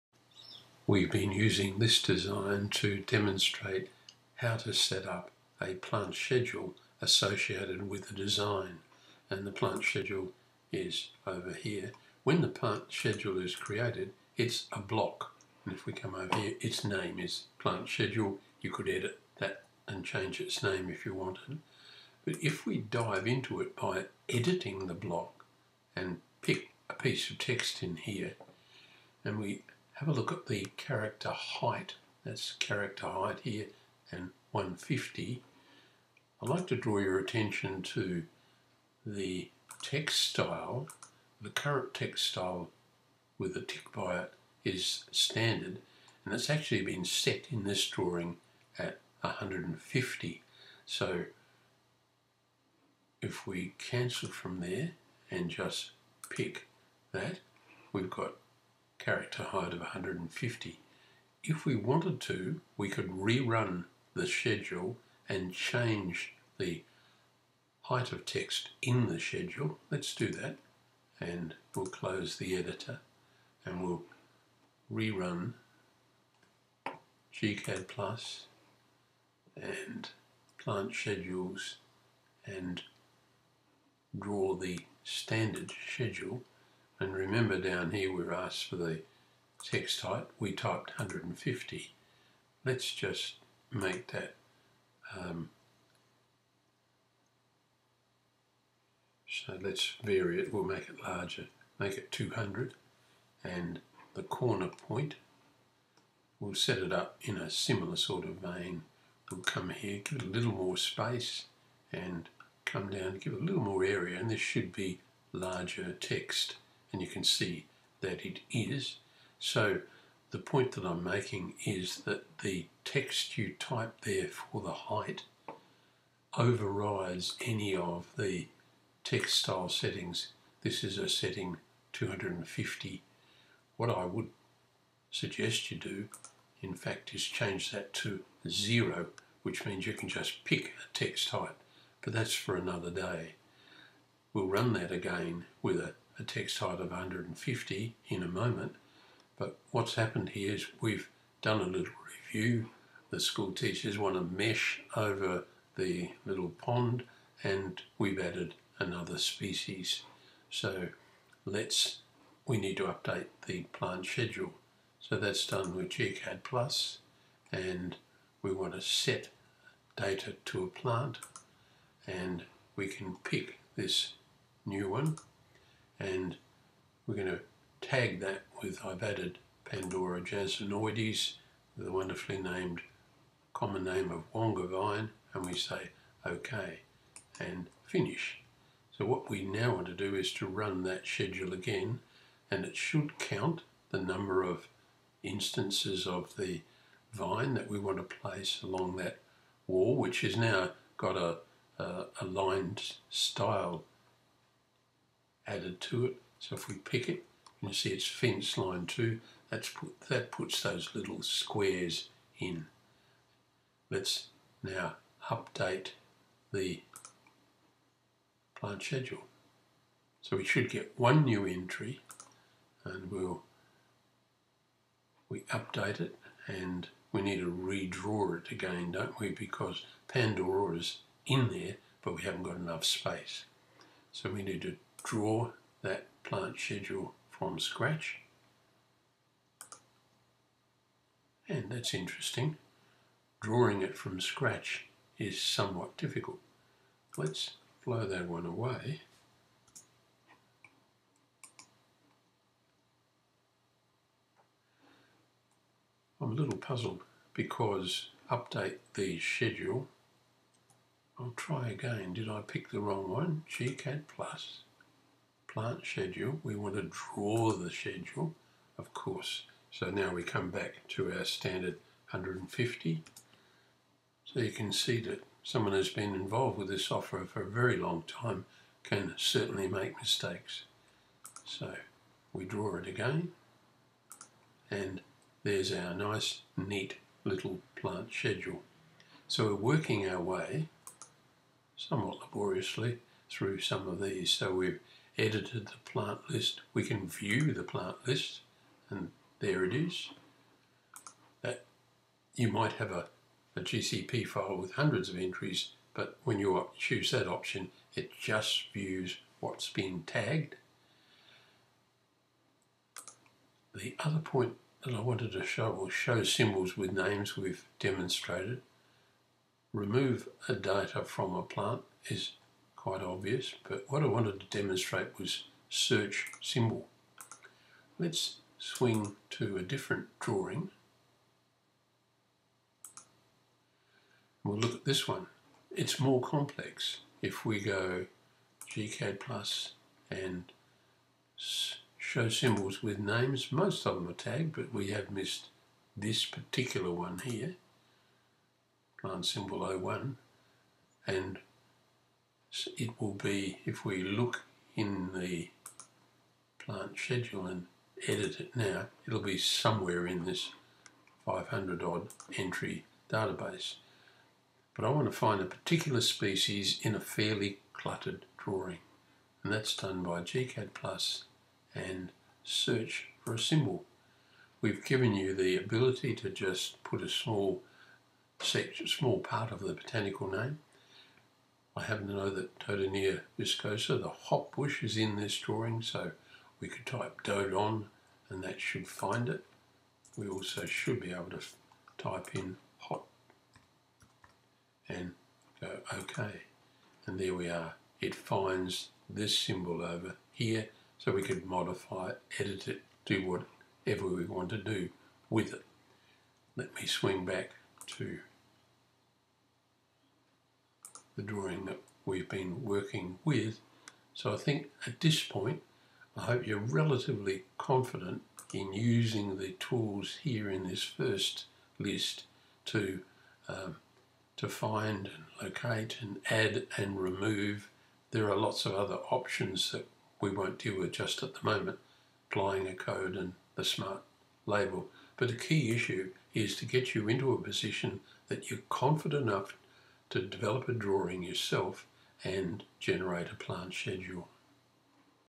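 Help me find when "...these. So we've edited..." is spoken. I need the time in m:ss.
4:53.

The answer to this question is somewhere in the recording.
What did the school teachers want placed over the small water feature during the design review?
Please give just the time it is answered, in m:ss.
2:34.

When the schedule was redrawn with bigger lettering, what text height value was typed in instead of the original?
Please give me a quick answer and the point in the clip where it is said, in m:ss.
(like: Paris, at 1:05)
200, at 1:41.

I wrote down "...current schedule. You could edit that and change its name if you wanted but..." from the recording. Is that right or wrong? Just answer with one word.
wrong.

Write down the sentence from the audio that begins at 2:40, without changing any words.
So let's, we need to update the plant schedule.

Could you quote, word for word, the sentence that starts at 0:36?
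I'd like to draw your attention to the text style.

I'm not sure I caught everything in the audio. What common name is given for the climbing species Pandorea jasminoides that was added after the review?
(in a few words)
Wonga vine.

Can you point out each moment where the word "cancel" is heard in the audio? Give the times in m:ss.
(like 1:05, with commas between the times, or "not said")
0:53.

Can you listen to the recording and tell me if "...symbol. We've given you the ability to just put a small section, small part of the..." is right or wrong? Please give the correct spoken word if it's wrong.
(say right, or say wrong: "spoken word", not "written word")
right.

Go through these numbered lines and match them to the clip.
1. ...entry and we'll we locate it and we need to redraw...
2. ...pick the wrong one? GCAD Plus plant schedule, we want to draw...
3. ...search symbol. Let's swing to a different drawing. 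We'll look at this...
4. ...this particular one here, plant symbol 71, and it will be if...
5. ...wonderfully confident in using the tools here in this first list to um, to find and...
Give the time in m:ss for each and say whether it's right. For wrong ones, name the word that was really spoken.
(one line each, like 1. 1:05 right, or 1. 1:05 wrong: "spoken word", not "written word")
1. 3:41 wrong: "update", not "locate"
2. 4:22 right
3. 5:25 right
4. 5:45 wrong: "01", not "71"
5. 6:56 wrong: "relatively", not "wonderfully".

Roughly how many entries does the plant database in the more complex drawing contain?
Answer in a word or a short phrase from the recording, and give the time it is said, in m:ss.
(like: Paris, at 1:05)
500, at 6:01.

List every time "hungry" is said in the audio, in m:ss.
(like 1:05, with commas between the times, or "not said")
not said.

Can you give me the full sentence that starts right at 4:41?
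So we draw it again and there's our nice neat little plant schedule.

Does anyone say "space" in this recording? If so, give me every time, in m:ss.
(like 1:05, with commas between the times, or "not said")
1:50, 3:52.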